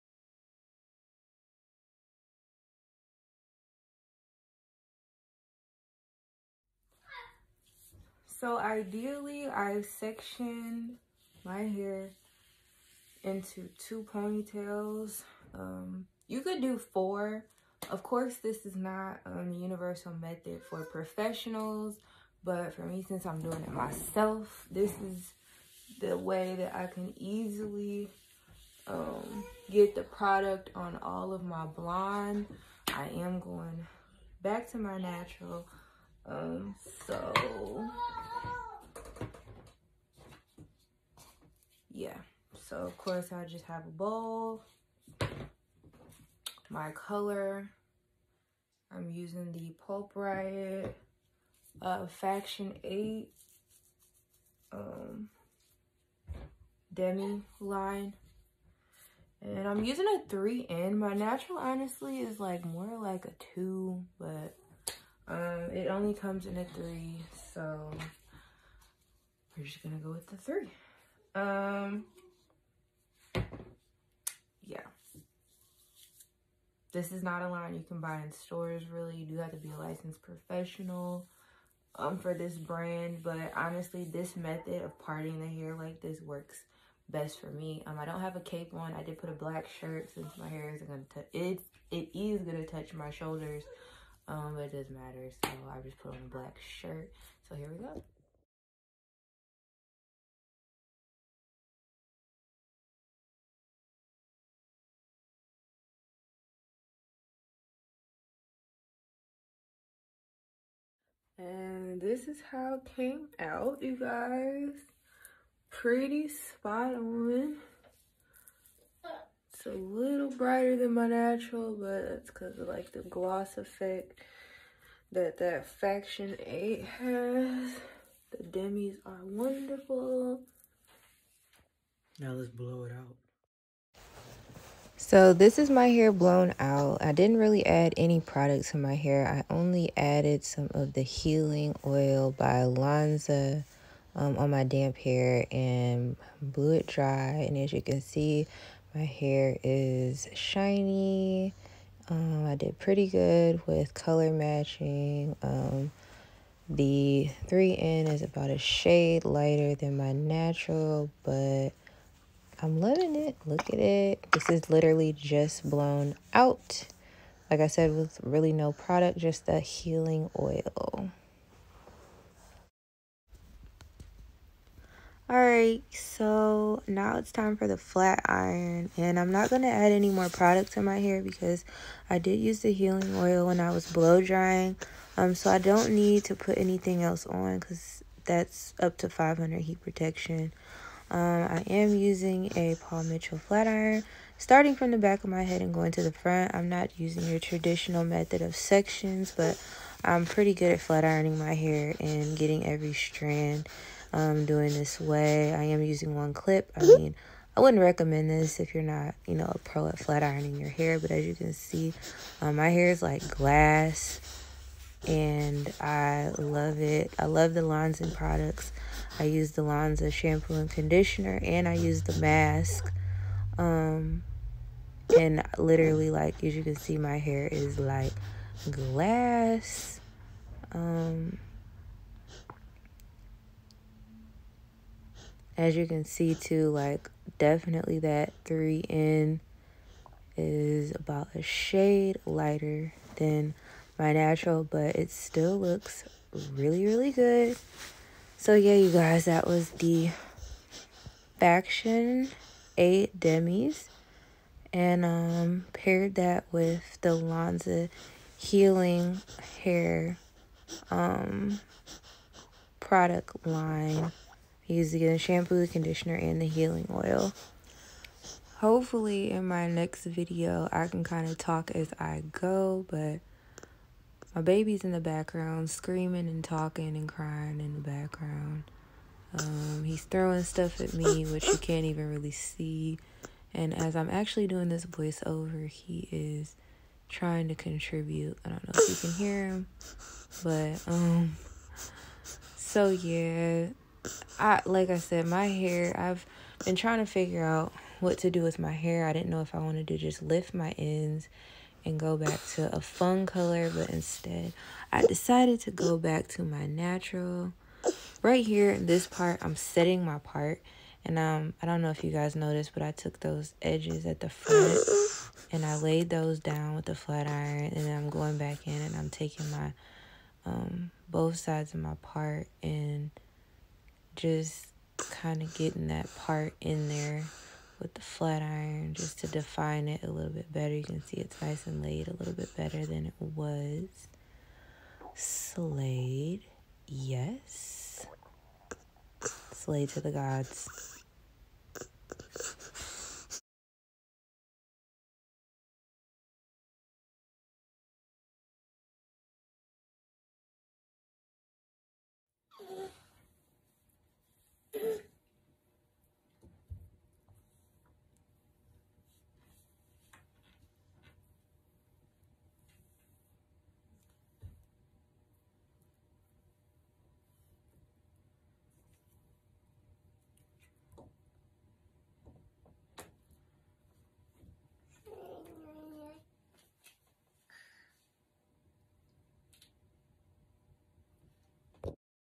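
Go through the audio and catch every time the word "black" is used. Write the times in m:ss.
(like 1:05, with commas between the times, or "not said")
1:29, 1:36.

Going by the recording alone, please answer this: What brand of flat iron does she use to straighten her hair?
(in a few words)
Paul Mitchell.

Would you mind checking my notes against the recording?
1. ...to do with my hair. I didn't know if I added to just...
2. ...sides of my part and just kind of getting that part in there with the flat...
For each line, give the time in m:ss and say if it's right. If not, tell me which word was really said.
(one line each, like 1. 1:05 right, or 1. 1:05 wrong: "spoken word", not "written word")
1. 4:58 wrong: "wanted", not "added"
2. 5:21 right.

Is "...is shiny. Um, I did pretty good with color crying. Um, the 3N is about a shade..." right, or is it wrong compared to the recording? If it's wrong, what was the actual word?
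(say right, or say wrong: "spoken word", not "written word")
wrong: "matching", not "crying".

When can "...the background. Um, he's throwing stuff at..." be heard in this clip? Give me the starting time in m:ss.
4:37.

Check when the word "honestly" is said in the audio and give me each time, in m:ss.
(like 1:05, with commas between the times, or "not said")
1:01, 1:23.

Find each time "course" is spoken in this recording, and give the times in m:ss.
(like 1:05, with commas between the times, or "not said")
0:18, 0:42.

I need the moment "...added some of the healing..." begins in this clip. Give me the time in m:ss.
2:19.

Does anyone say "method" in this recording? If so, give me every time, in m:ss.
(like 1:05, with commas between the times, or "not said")
0:20, 1:24, 3:18.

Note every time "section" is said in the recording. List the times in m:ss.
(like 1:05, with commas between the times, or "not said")
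0:09, 3:18.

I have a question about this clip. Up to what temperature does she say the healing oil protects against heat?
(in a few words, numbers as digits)
500.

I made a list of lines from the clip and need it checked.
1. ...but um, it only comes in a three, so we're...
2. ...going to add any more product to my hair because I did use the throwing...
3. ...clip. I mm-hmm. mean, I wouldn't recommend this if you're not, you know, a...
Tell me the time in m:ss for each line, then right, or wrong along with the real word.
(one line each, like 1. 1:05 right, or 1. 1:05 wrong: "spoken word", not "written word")
1. 1:04 right
2. 2:59 wrong: "healing", not "throwing"
3. 3:26 right.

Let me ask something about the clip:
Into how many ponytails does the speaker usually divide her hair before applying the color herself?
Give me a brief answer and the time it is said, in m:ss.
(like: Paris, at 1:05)
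2, at 0:13.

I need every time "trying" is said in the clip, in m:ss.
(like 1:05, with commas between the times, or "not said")
4:47, 4:56.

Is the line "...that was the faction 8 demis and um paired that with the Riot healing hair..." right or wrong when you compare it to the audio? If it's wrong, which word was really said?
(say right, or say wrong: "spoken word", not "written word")
wrong: "Lanza", not "Riot".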